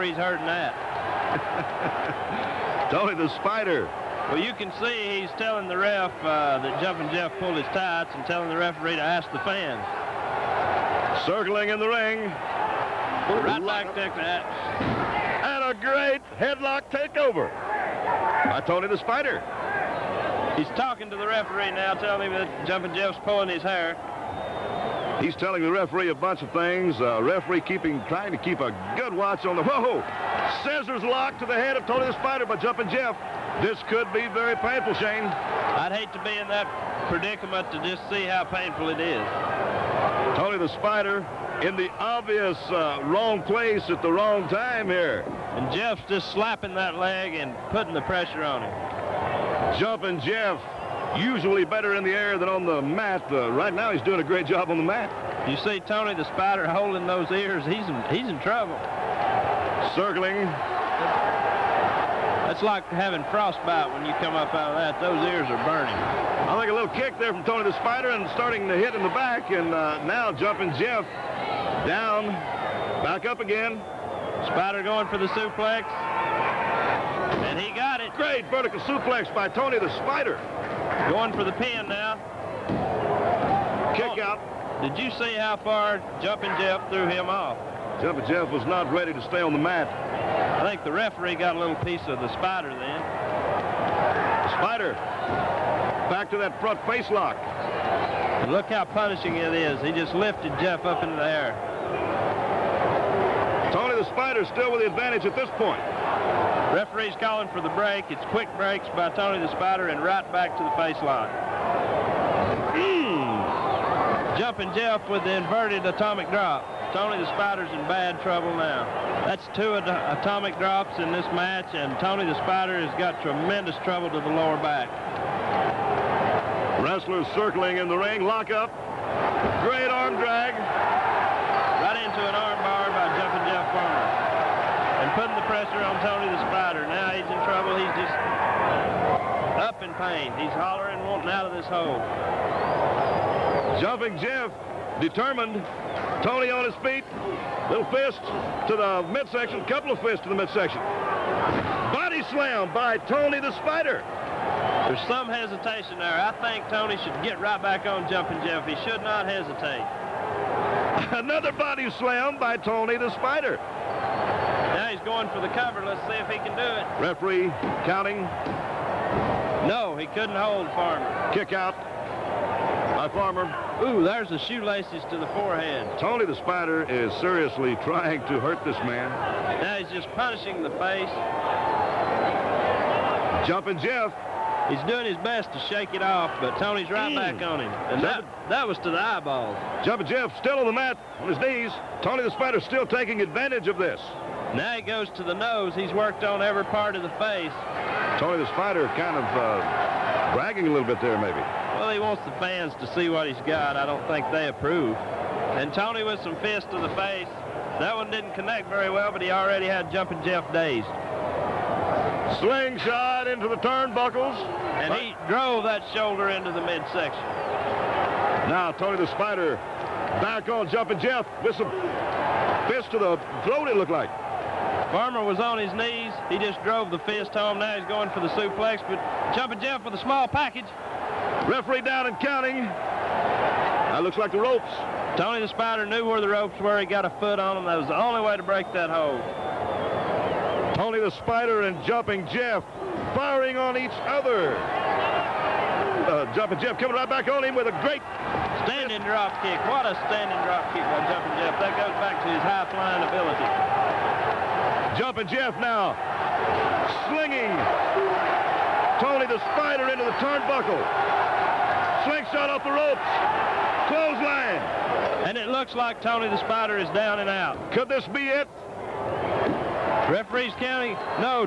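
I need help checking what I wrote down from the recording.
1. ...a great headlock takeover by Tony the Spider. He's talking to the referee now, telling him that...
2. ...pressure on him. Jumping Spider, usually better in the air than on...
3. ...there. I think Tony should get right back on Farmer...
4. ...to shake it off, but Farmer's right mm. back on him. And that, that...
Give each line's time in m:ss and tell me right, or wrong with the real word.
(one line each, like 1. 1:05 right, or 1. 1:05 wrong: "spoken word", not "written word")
1. 0:15 right
2. 0:48 wrong: "Jeff", not "Spider"
3. 2:35 wrong: "Jumping", not "Farmer"
4. 3:05 wrong: "Tony", not "Farmer".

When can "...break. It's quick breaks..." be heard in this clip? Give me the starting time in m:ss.
1:47.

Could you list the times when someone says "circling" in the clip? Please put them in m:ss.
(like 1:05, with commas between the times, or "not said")
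0:11, 0:59, 2:07.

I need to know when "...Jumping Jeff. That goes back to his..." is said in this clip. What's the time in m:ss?
4:11.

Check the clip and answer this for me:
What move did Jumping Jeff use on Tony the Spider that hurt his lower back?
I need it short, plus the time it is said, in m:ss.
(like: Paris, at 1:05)
Inverted atomic drop, at 1:55.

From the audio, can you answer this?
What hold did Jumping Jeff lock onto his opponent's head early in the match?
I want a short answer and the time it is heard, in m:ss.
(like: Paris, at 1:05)
Scissors, at 0:30.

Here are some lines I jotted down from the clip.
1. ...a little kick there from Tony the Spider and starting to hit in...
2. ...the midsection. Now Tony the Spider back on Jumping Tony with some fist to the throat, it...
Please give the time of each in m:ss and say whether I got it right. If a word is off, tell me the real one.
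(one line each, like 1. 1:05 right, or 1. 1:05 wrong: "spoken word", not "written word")
1. 1:06 right
2. 3:36 wrong: "Jeff", not "Tony".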